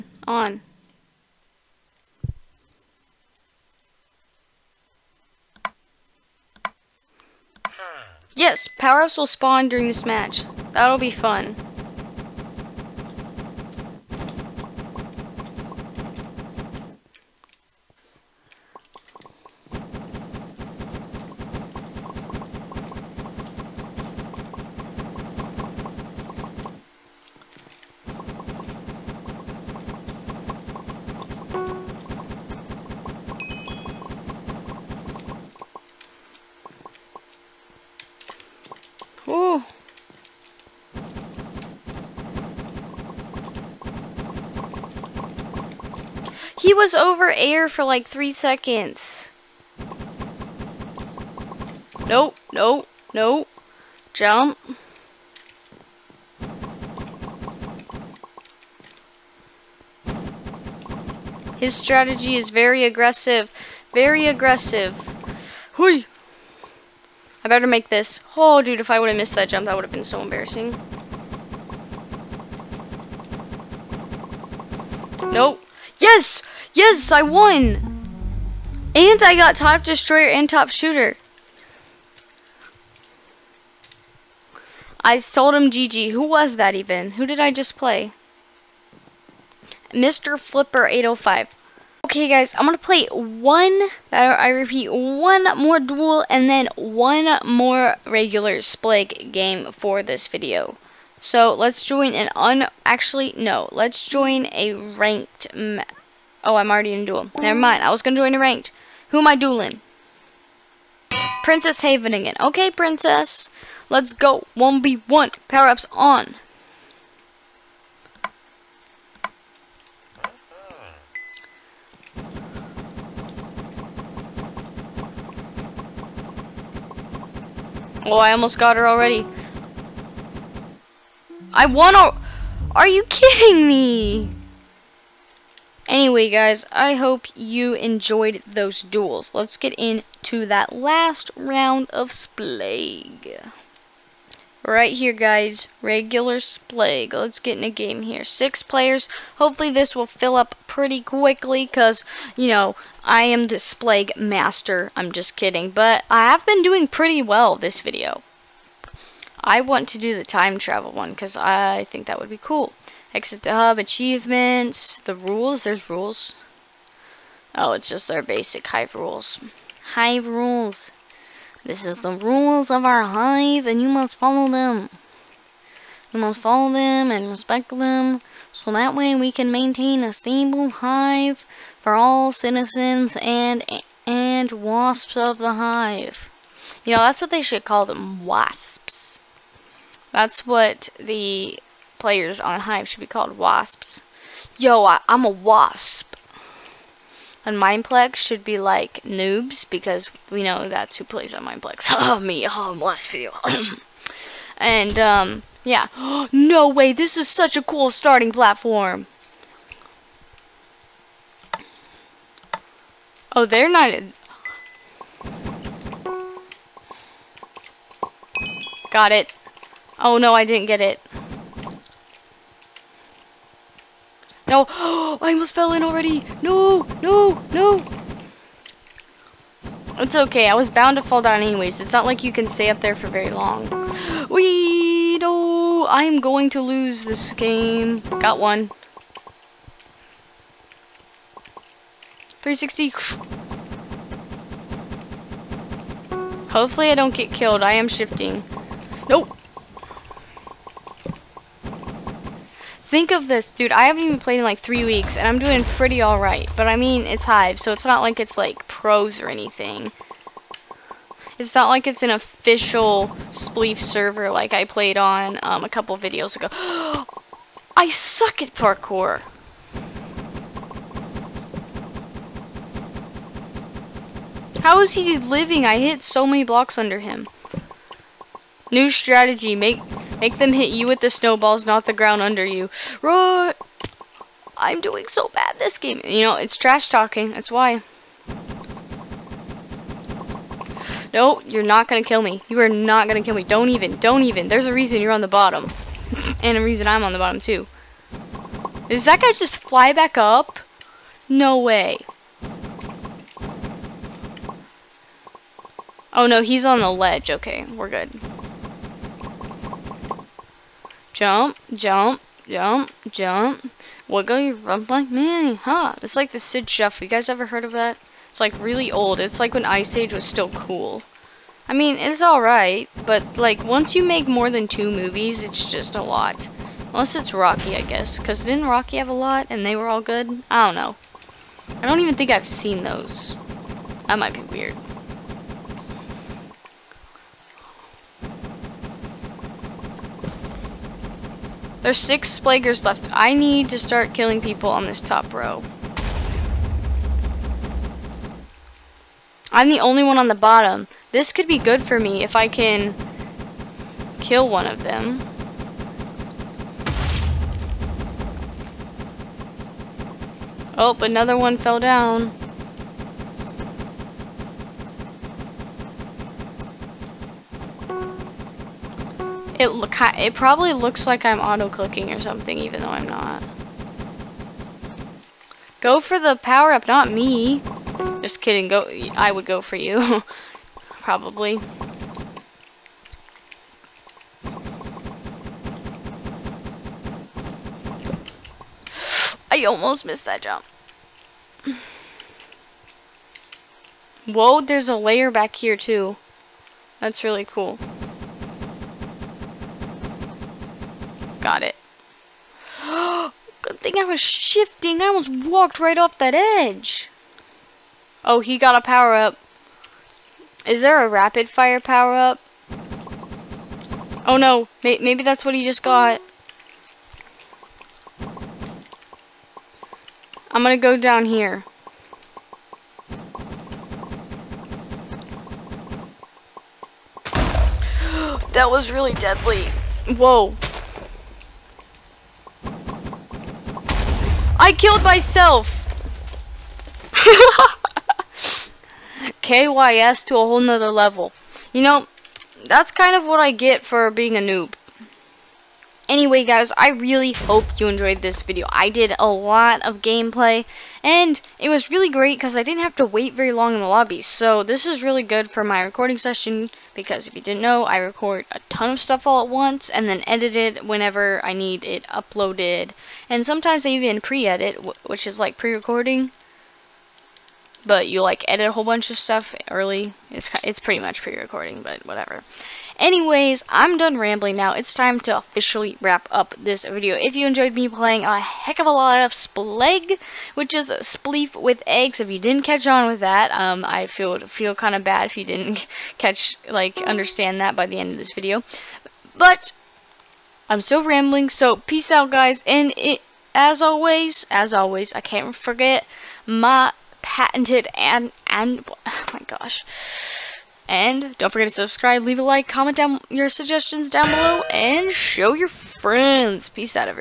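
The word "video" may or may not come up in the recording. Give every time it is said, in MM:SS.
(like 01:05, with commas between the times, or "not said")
01:40, 02:37, 03:23, 04:25, 07:28, 07:56, 08:08.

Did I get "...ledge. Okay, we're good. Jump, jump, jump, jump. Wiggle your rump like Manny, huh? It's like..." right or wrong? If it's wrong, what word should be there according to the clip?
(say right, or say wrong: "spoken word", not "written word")
right.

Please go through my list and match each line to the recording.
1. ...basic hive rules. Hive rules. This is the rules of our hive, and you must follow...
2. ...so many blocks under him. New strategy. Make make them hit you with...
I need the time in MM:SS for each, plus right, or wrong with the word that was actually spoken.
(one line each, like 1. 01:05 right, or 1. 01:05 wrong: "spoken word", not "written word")
1. 02:48 right
2. 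04:36 right.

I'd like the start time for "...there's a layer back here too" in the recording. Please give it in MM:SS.
06:34.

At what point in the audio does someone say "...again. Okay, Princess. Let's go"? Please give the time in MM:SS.
01:52.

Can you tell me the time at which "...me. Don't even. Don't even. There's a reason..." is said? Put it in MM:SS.
04:53.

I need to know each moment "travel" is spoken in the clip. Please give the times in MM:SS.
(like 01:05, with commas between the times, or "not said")
02:40.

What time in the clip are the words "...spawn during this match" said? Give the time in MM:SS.
00:09.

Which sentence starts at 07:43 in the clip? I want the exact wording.
And sometimes I even pre-edit, which is like pre-recording.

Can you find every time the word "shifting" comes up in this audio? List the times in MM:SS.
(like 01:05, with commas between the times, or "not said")
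04:07, 06:44.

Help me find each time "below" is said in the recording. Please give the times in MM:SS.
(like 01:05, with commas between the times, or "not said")
08:24.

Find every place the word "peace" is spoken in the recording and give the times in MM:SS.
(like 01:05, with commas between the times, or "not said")
08:11, 08:26.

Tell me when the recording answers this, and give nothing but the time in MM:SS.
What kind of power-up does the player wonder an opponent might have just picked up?
06:51.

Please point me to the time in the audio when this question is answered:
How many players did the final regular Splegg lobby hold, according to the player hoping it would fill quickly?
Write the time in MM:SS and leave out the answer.
02:28.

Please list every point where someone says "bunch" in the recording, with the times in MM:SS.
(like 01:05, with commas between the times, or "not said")
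07:48.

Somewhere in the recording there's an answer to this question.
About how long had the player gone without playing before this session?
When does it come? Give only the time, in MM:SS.
04:14.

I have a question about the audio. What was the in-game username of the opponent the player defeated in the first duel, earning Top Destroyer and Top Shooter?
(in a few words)
Mr. Flipper 805.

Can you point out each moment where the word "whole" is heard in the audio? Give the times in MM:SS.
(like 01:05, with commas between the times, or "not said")
07:20, 07:48.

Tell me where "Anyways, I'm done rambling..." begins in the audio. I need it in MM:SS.
07:52.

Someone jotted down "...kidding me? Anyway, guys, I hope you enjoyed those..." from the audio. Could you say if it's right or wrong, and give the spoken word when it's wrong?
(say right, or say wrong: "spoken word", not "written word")
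right.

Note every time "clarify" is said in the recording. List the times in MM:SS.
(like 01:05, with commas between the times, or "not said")
not said.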